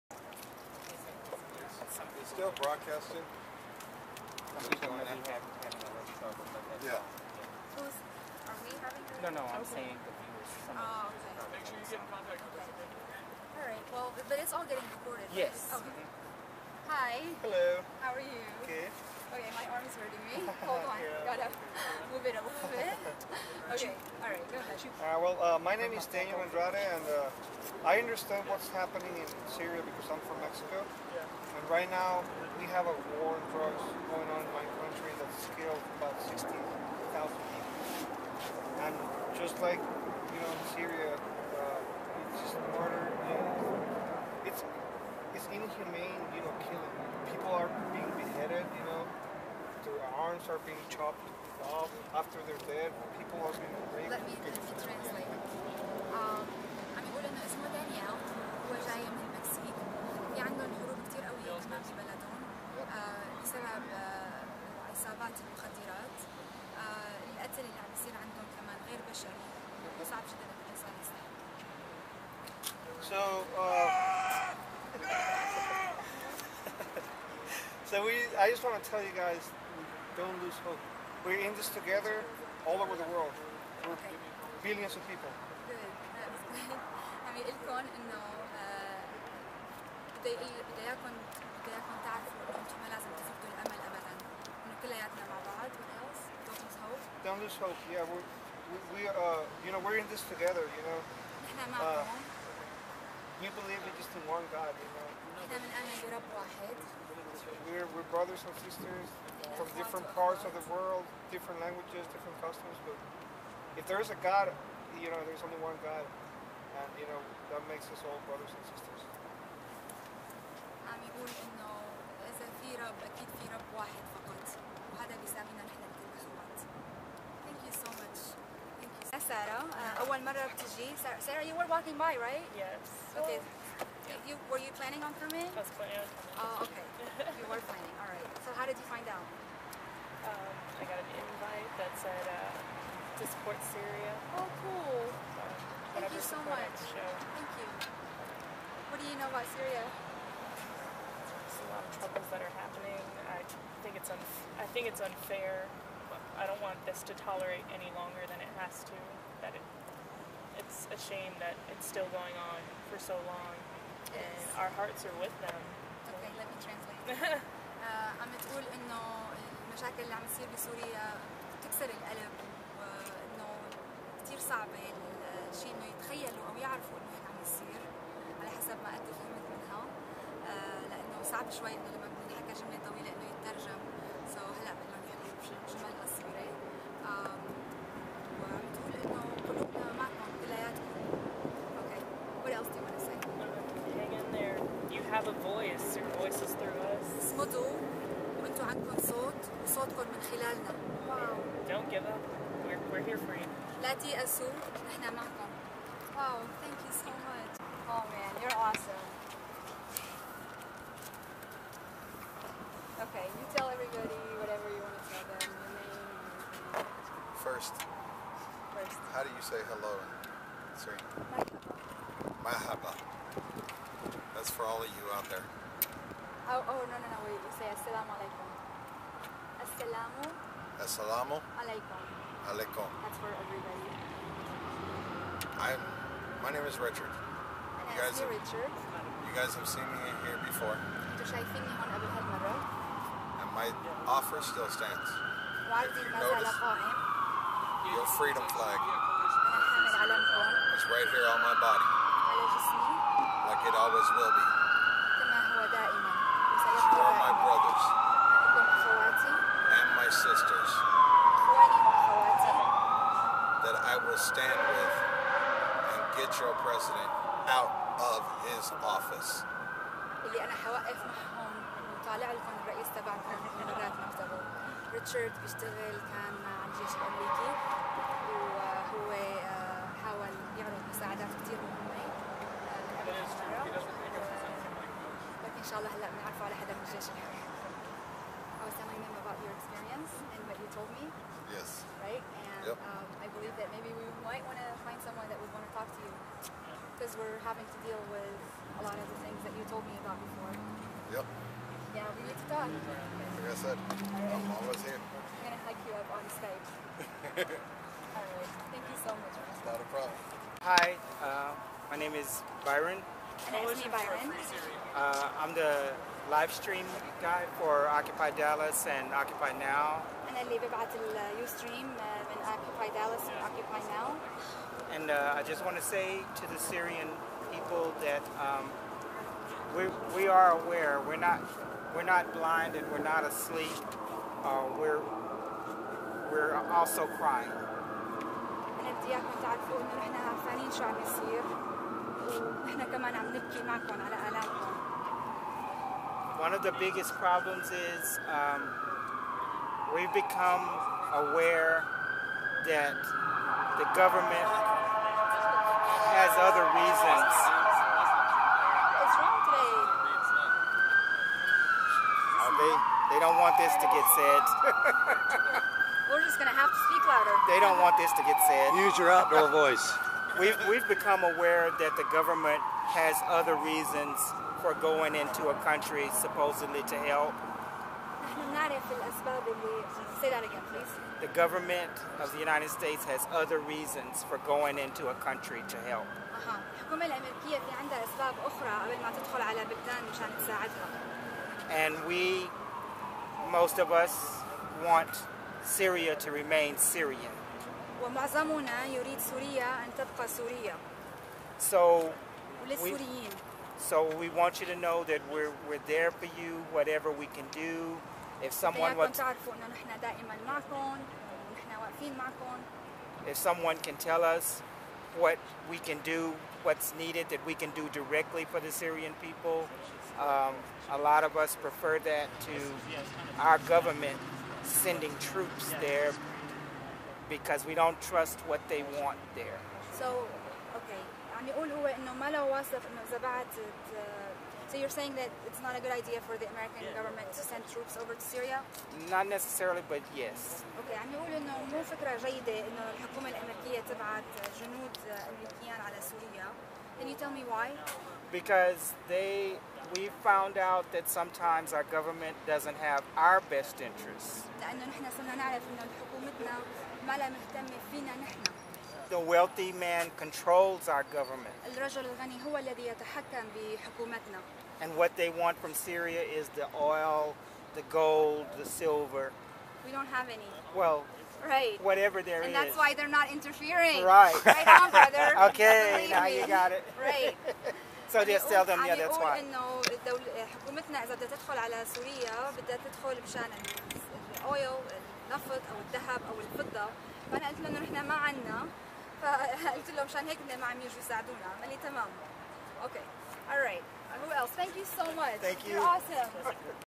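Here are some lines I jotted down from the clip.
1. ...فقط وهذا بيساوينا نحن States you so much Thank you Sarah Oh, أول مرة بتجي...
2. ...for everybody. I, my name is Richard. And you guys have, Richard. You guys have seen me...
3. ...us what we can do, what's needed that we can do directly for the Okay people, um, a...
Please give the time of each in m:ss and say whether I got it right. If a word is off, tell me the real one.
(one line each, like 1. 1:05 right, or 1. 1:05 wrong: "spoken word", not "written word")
1. 2:04 wrong: "Thank", not "States"
2. 3:53 right
3. 6:54 wrong: "Syrian", not "Okay".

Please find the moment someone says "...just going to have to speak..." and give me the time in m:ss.
6:06.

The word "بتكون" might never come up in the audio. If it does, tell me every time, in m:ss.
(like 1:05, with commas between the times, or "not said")
3:02.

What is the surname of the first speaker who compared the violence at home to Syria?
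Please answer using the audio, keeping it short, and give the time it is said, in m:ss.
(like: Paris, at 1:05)
Andrade, at 0:26.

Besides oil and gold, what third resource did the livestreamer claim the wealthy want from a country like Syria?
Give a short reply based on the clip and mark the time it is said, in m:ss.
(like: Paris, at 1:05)
silver, at 7:48.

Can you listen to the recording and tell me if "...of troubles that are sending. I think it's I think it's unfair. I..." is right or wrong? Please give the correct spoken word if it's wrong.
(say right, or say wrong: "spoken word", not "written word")
wrong: "happening", not "sending".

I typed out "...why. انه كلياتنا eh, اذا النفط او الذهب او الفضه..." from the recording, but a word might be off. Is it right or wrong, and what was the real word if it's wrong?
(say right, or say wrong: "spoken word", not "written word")
wrong: "حكومتنا", not "كلياتنا".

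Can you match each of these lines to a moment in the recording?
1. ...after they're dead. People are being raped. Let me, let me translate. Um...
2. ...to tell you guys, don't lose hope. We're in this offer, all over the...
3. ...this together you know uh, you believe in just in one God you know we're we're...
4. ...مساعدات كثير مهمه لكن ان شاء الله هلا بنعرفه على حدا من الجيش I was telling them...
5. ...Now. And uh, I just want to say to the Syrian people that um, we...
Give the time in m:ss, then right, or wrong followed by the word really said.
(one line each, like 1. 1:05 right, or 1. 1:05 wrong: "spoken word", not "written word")
1. 0:52 right
2. 1:18 wrong: "together", not "offer"
3. 1:40 right
4. 4:40 right
5. 5:23 right.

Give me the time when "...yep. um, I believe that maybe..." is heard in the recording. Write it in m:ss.
4:52.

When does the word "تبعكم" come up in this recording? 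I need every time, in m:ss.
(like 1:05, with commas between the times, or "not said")
4:32.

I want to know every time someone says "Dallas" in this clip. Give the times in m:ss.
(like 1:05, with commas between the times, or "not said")
5:18, 5:22.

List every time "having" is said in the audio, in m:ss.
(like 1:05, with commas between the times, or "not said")
0:08, 4:57.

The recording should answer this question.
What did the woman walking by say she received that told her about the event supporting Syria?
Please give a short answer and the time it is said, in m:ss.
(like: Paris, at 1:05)
an invite, at 2:21.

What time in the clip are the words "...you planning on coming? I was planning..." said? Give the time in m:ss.
2:14.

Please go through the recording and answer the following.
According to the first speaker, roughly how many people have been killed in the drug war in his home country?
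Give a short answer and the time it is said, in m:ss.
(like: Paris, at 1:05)
60,000, at 0:36.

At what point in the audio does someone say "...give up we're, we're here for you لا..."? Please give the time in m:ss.
3:21.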